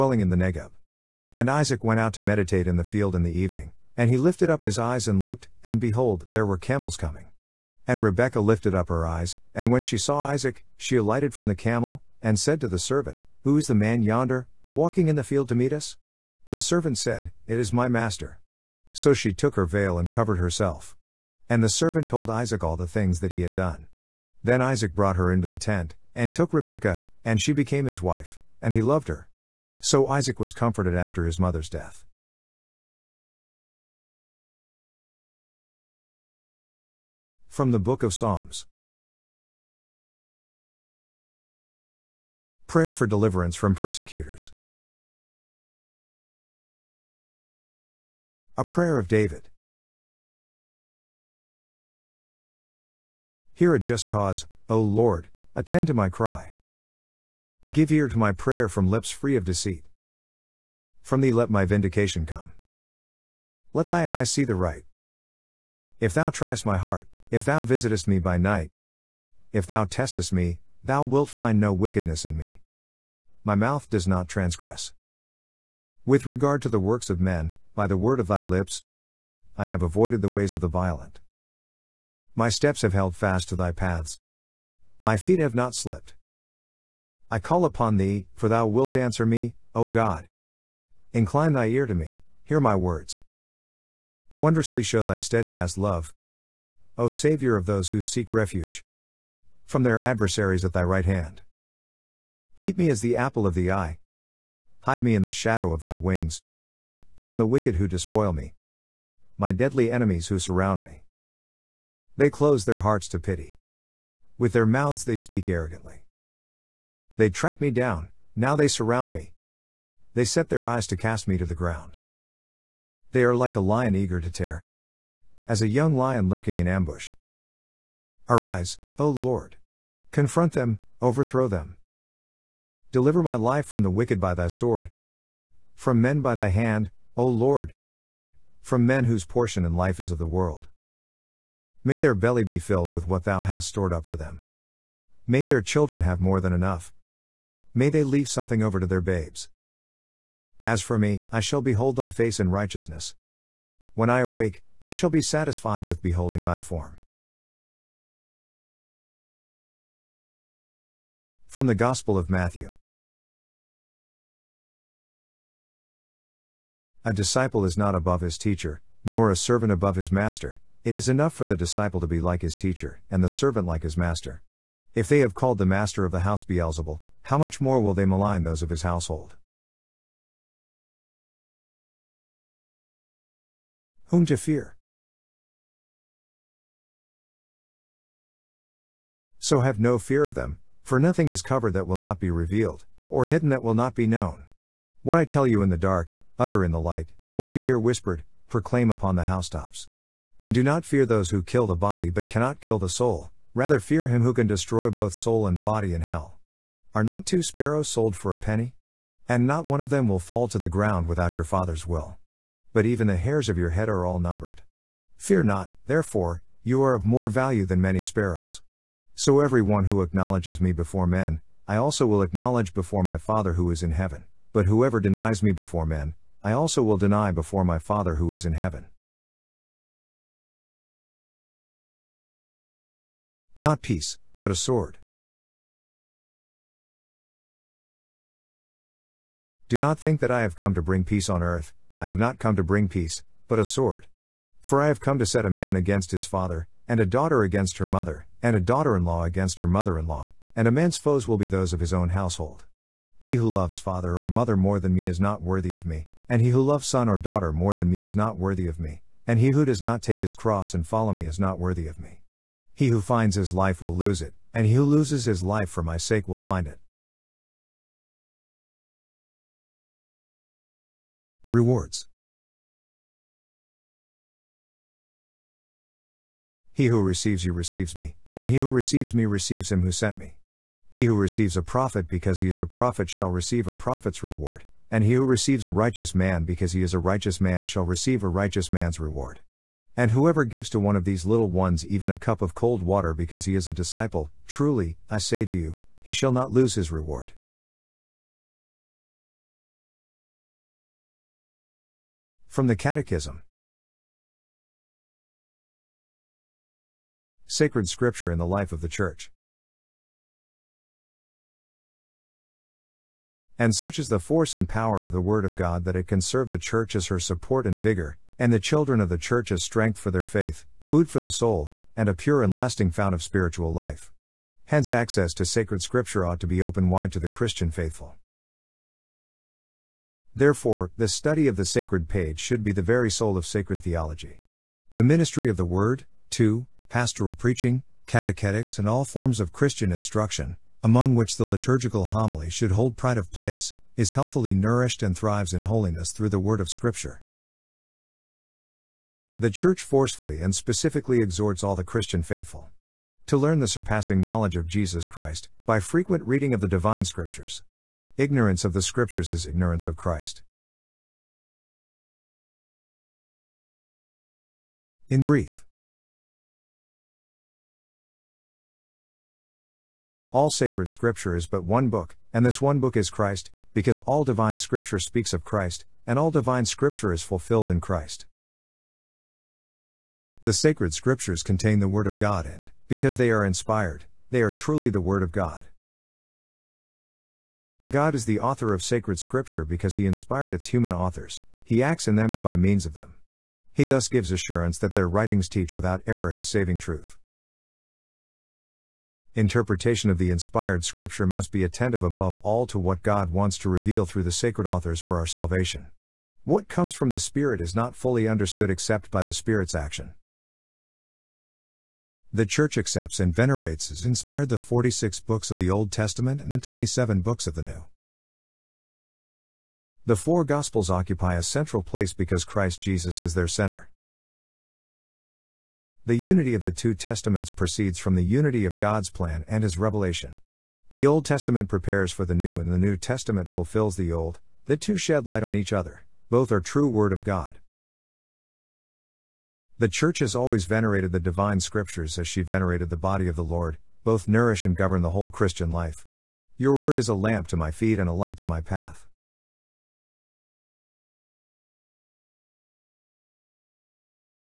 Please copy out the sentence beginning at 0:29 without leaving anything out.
So Isaac was comforted after his mother's death.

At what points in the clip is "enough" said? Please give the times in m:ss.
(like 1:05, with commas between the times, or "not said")
2:26, 2:51.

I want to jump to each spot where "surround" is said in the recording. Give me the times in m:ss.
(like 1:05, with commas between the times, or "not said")
1:50, 1:58.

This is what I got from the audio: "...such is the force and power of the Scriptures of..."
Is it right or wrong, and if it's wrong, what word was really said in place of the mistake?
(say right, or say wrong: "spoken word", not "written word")
wrong: "Word", not "Scriptures".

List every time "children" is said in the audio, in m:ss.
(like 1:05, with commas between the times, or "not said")
2:25, 5:18.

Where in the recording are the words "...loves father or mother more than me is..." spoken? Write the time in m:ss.
4:13.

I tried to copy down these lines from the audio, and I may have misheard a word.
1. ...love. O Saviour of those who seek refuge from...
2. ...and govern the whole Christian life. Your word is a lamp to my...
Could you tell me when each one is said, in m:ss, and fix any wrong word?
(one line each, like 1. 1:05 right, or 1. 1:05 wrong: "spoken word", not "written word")
1. 1:35 right
2. 7:24 right.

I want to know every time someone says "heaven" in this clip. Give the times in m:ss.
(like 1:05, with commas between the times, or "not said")
3:43, 3:48.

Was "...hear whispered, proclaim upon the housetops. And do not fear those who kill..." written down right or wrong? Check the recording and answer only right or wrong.
right.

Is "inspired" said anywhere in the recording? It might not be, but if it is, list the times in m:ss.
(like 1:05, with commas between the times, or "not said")
6:23, 6:30, 6:40, 6:54.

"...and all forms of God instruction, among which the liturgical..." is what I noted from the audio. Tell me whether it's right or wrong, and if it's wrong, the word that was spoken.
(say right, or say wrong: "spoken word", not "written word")
wrong: "Christian", not "God".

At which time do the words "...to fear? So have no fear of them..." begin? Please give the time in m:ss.
3:04.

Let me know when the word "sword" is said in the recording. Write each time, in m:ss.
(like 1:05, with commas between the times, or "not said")
2:14, 3:54, 4:03.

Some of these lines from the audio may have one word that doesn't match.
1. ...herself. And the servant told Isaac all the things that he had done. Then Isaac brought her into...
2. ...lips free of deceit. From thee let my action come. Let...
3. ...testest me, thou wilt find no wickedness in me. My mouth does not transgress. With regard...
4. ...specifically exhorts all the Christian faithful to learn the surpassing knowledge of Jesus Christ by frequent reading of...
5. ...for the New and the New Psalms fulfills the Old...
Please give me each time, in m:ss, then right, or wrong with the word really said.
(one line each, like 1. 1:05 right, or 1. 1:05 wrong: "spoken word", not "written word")
1. 0:20 right
2. 0:58 wrong: "vindication", not "action"
3. 1:09 right
4. 5:50 right
5. 7:12 wrong: "Testament", not "Psalms".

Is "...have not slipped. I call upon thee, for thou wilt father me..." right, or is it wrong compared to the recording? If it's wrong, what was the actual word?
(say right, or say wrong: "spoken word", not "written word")
wrong: "answer", not "father".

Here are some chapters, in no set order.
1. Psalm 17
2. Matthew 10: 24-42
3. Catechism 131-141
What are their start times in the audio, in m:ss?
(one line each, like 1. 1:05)
1. 0:37
2. 2:41
3. 5:02.